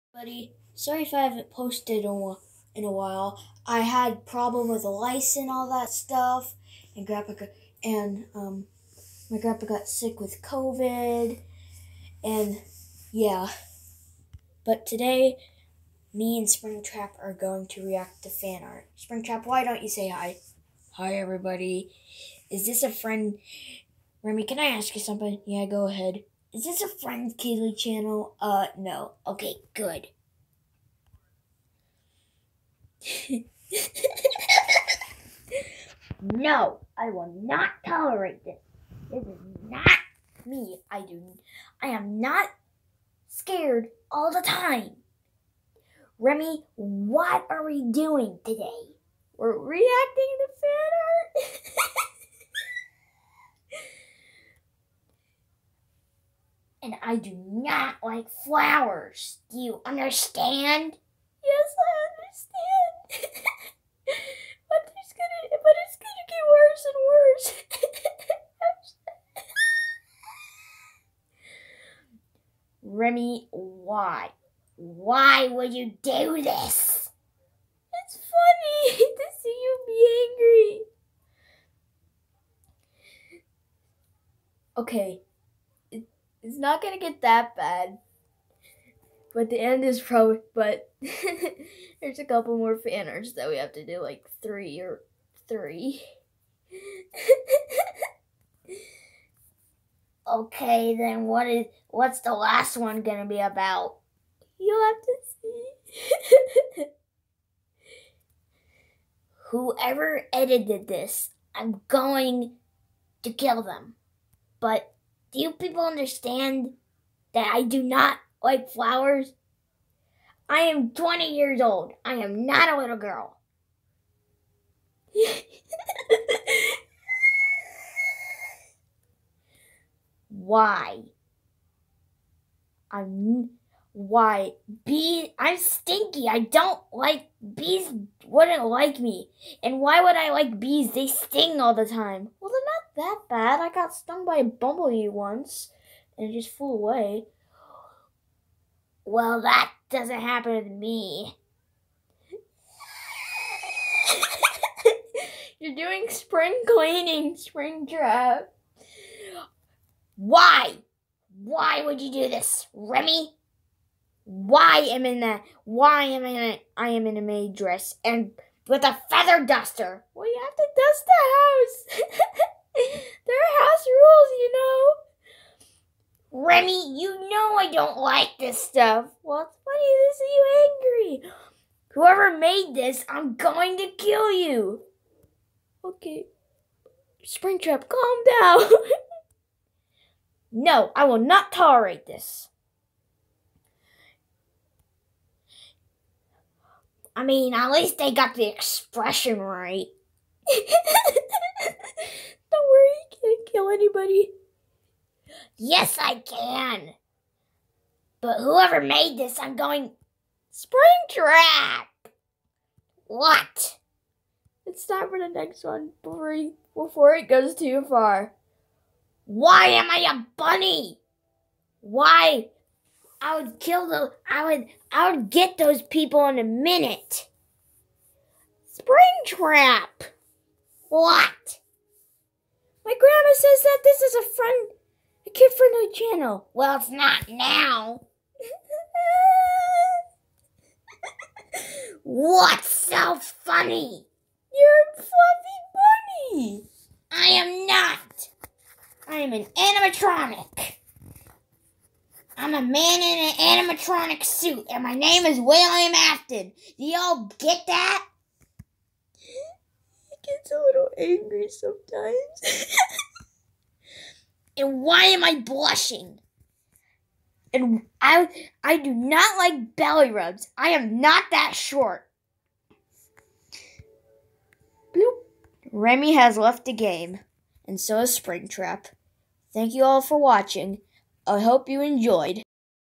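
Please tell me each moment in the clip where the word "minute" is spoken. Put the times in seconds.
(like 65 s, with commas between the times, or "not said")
226 s.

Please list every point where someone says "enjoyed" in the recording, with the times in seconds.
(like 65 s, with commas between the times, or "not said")
281 s.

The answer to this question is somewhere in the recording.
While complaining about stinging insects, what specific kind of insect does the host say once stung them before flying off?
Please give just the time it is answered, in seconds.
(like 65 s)
144 s.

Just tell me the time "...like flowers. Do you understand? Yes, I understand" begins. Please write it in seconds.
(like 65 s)
58 s.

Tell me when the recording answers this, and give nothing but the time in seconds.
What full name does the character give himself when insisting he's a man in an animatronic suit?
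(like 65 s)
255 s.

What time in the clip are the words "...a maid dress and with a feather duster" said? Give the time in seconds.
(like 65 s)
167 s.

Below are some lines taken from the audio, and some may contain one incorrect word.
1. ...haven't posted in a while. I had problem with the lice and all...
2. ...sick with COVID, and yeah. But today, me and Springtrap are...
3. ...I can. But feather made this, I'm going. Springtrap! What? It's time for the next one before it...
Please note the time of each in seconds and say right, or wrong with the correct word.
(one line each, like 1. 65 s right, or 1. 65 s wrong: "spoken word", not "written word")
1. 1 s right
2. 9 s right
3. 205 s wrong: "whoever", not "feather".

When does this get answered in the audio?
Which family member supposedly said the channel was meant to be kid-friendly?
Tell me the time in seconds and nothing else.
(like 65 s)
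232 s.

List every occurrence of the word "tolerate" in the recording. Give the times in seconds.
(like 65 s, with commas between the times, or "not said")
37 s, 191 s.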